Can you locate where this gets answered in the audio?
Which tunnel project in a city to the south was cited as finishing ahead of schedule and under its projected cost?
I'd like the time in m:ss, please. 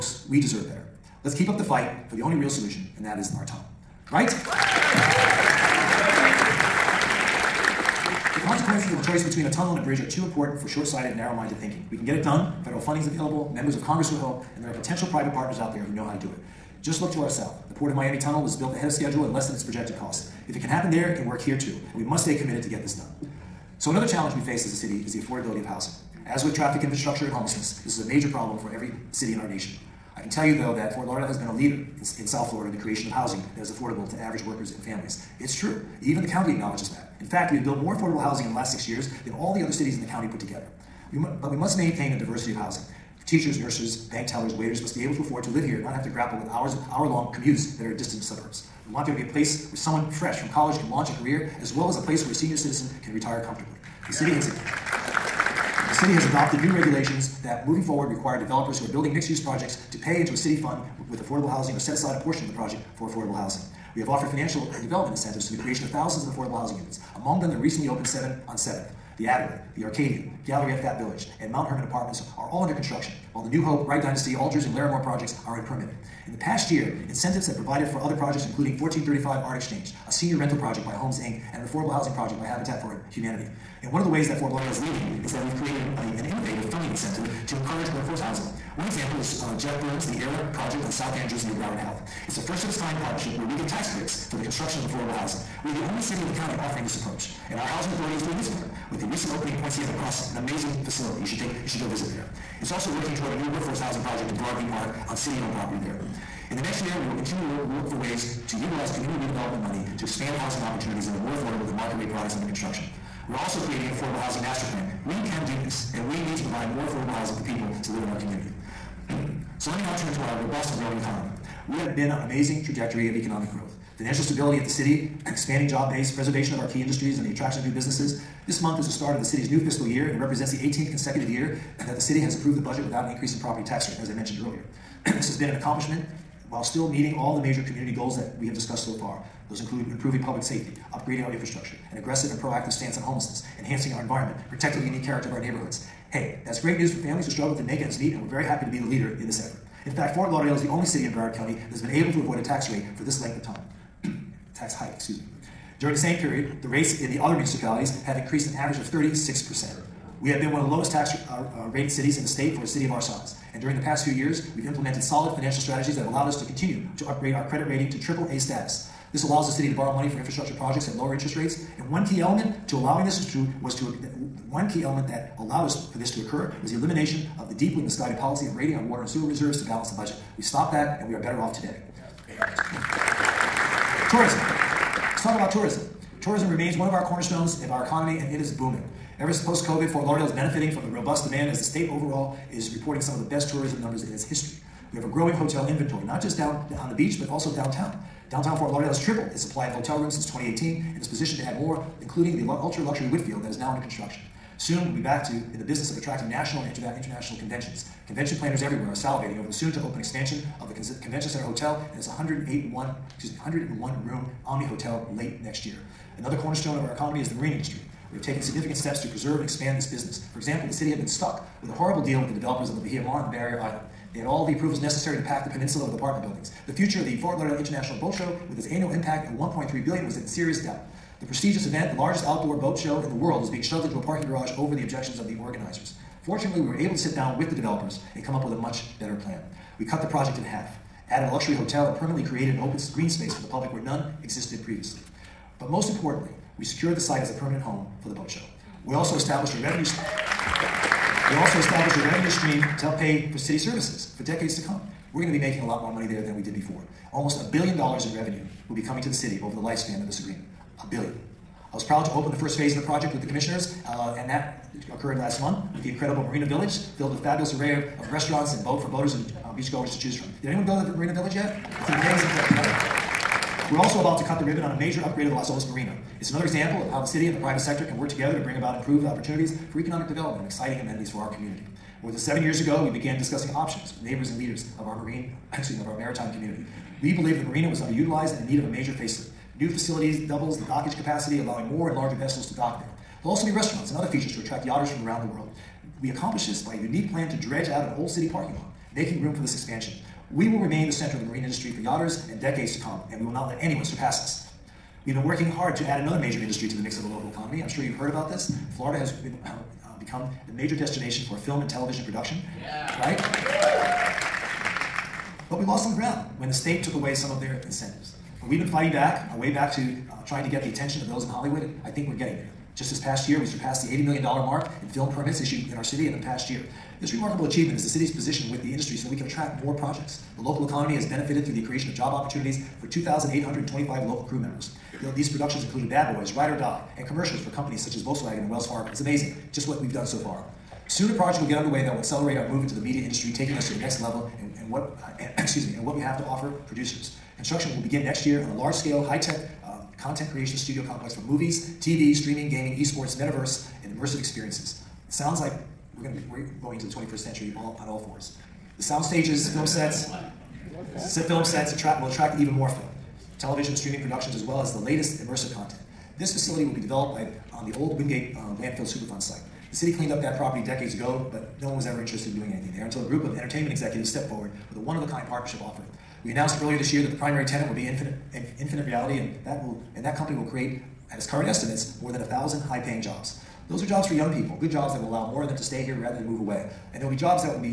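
0:17.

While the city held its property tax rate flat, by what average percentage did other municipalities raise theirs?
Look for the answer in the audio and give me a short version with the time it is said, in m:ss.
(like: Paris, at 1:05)
36%, at 2:38.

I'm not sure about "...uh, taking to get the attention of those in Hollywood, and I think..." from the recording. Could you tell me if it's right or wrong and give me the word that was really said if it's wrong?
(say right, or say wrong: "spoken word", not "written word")
wrong: "trying", not "taking".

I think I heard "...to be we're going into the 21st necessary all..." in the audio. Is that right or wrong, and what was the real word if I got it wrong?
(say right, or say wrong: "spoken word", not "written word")
wrong: "century", not "necessary".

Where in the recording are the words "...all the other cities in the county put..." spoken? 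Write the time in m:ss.
0:39.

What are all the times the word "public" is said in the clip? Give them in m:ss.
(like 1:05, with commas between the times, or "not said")
2:20, 4:03.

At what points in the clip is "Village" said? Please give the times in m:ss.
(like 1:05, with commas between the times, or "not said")
1:11, 4:26, 4:31.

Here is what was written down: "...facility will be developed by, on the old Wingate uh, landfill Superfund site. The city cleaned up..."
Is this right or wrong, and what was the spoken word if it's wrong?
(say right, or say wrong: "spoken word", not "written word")
right.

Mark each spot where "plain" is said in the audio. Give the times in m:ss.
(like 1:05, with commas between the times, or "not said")
not said.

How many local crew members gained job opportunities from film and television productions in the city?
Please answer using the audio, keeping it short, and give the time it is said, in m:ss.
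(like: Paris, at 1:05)
2,825, at 5:32.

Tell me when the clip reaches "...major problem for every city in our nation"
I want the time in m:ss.
0:28.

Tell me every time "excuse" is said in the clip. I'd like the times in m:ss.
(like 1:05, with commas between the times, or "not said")
2:34, 4:45, 5:45.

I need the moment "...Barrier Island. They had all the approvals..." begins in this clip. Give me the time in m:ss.
3:43.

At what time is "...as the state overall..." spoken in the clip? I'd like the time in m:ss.
3:11.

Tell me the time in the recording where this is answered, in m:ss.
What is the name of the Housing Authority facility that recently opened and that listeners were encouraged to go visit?
1:39.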